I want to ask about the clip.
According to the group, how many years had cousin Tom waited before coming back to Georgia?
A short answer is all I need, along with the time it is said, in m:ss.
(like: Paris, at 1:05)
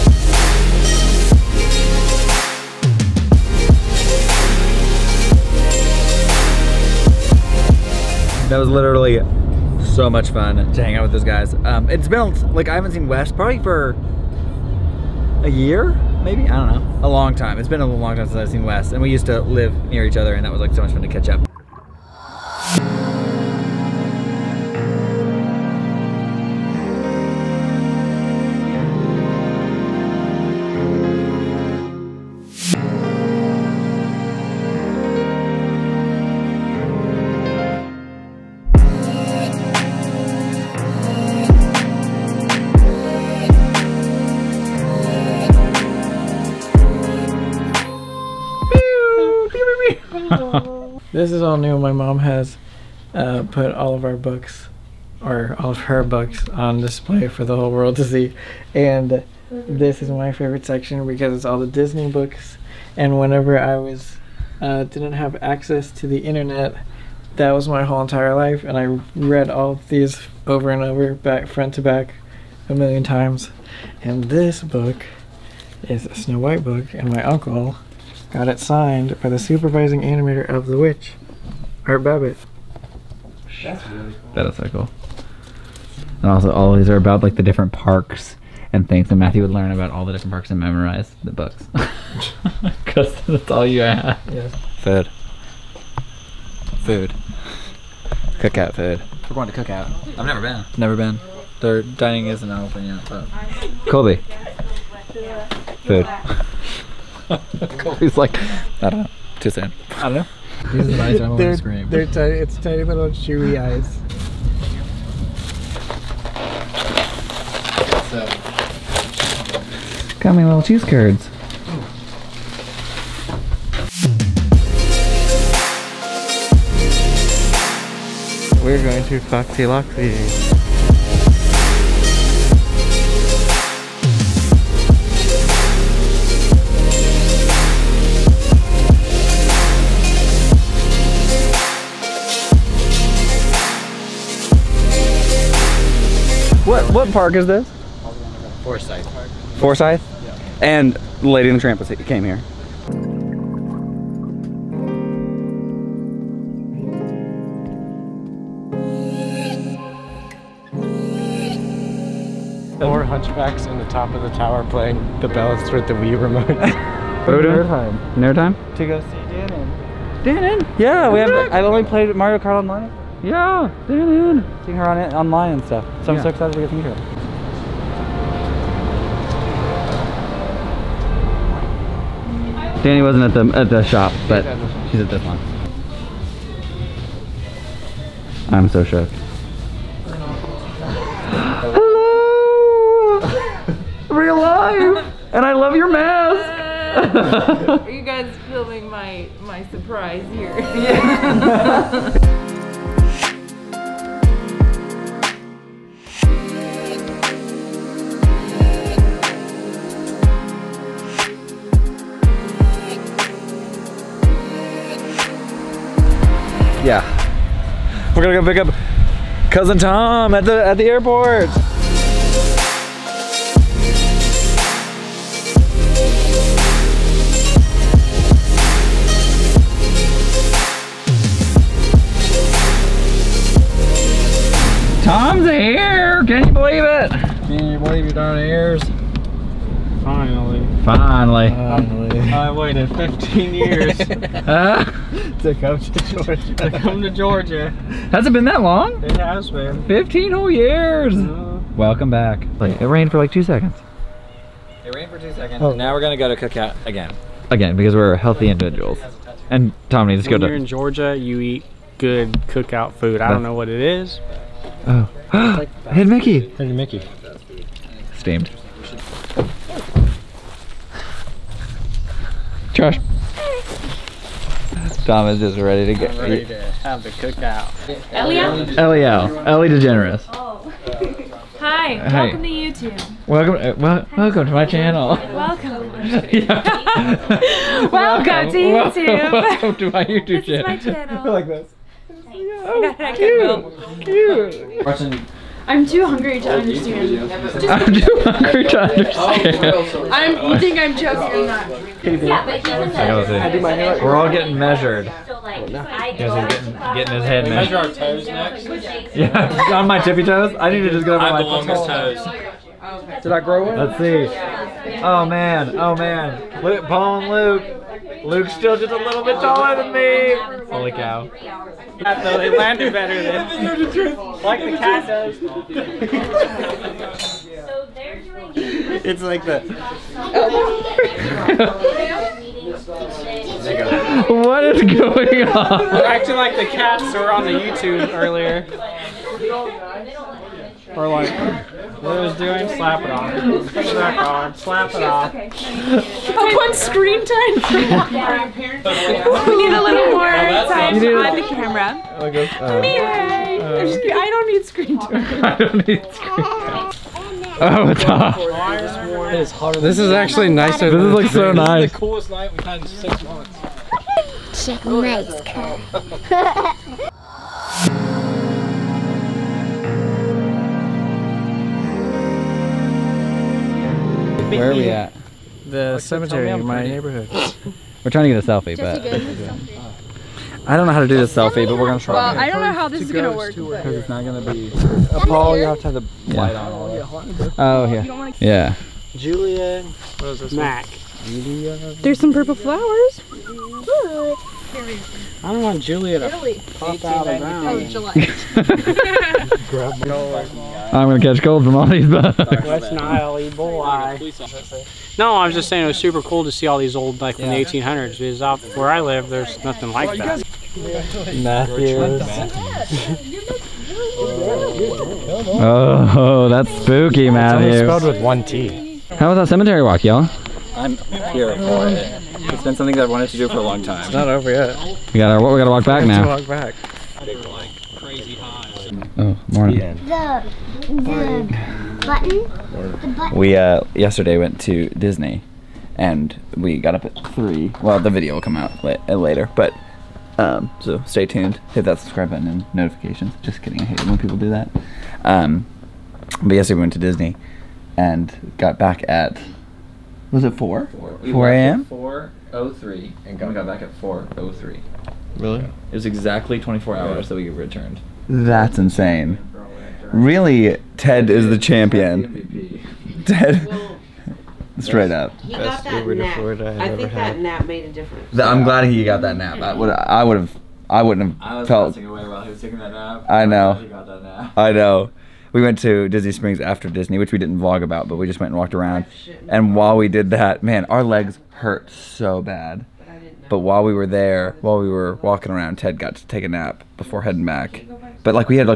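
15, at 4:02.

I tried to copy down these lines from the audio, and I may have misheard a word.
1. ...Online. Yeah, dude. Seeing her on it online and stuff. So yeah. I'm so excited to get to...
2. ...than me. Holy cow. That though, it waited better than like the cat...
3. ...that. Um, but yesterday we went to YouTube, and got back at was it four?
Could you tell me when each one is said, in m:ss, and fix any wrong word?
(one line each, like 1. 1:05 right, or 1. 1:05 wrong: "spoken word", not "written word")
1. 2:52 right
2. 5:19 wrong: "landed", not "waited"
3. 7:24 wrong: "Disney", not "YouTube".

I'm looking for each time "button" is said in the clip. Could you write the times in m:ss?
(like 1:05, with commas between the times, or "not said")
7:12, 7:22.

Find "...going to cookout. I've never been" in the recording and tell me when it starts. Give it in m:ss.
1:39.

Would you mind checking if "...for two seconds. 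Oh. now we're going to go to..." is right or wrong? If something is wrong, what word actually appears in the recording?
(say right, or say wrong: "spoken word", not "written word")
right.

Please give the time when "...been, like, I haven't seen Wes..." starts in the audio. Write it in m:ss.
0:12.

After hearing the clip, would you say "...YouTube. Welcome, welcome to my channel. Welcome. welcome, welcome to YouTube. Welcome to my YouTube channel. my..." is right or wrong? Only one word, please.
right.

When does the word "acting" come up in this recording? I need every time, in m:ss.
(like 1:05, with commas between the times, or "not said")
5:36.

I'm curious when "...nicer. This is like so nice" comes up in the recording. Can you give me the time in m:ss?
6:00.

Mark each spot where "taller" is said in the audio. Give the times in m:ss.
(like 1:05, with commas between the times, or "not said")
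5:19.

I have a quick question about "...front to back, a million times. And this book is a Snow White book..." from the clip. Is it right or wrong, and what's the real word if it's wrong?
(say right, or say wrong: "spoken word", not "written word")
right.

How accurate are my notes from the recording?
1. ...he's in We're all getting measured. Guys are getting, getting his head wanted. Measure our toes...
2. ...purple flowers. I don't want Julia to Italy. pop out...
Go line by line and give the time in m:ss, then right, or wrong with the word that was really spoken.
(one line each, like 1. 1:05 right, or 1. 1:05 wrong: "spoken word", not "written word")
1. 5:03 wrong: "measured", not "wanted"
2. 6:32 right.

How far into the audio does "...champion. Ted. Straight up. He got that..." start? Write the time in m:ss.
7:41.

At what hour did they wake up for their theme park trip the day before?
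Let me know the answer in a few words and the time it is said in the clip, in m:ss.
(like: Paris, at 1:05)
3, at 7:17.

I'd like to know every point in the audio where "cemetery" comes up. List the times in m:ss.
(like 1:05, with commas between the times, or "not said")
6:15, 6:59.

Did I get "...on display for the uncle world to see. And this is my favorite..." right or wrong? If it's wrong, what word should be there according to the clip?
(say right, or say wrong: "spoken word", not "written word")
wrong: "whole", not "uncle".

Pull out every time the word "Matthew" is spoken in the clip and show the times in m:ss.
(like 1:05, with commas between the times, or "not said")
1:29, 6:51, 6:57.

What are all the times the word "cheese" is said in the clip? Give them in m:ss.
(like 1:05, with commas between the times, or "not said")
2:00.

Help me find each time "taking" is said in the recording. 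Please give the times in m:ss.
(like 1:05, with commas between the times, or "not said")
7:52.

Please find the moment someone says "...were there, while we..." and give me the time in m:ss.
8:03.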